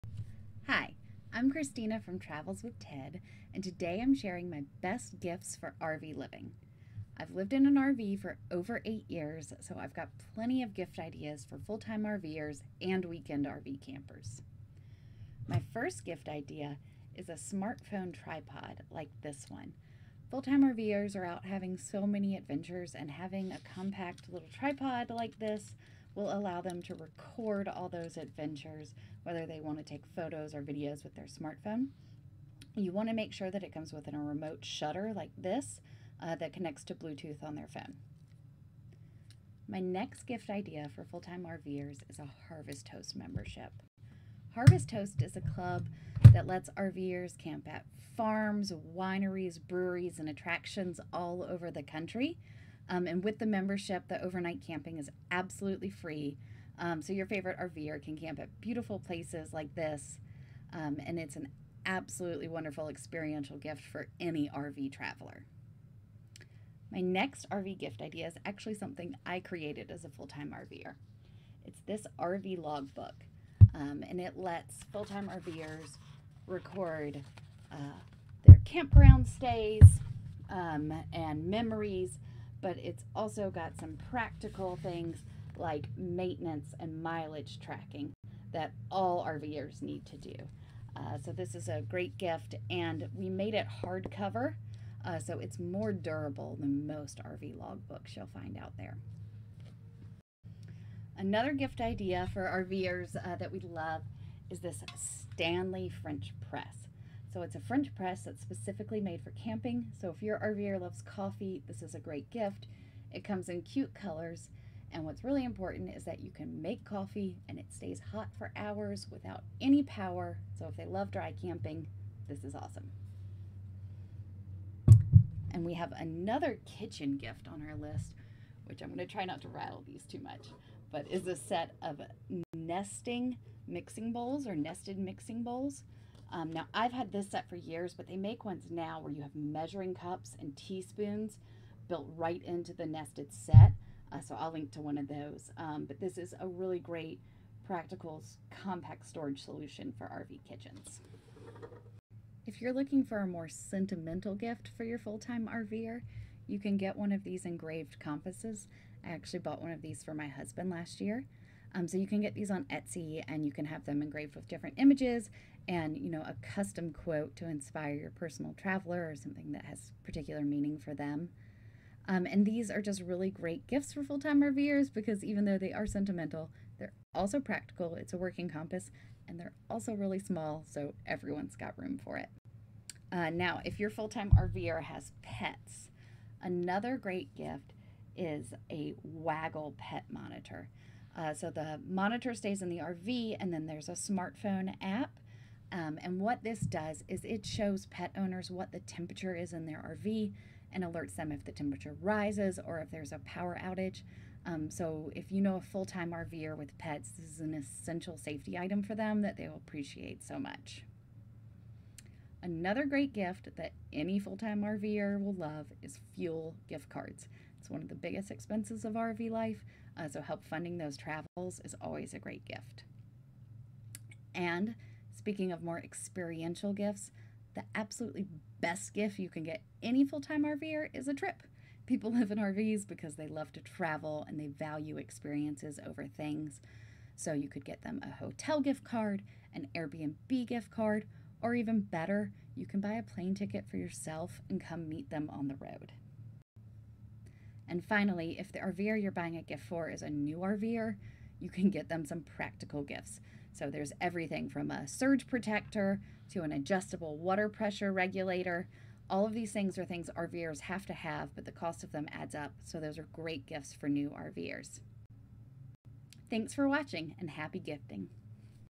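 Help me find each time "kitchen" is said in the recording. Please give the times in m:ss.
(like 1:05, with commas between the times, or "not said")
2:06, 2:30.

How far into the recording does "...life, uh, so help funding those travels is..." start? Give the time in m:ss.
3:39.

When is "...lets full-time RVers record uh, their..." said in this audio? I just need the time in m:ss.
1:14.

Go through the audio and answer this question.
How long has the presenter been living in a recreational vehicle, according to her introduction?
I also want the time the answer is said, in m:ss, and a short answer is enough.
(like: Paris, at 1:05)
Over 8 years, at 0:08.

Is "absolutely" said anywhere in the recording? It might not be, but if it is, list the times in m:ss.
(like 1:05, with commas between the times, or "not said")
0:55, 1:01, 3:47.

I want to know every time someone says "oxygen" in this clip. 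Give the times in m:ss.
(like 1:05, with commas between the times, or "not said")
not said.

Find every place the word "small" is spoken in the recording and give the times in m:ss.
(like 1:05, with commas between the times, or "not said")
3:00.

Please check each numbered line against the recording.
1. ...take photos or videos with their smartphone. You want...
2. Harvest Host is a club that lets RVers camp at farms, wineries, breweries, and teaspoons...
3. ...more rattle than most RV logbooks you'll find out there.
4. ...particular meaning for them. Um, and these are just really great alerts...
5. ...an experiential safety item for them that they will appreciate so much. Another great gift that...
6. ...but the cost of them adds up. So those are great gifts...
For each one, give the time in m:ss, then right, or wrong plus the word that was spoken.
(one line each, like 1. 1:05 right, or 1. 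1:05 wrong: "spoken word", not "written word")
1. 0:29 right
2. 0:44 wrong: "attractions", not "teaspoons"
3. 1:35 wrong: "durable", not "rattle"
4. 2:50 wrong: "gifts", not "alerts"
5. 3:27 wrong: "essential", not "experiential"
6. 4:21 right.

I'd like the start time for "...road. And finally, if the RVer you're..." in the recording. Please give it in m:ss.
4:05.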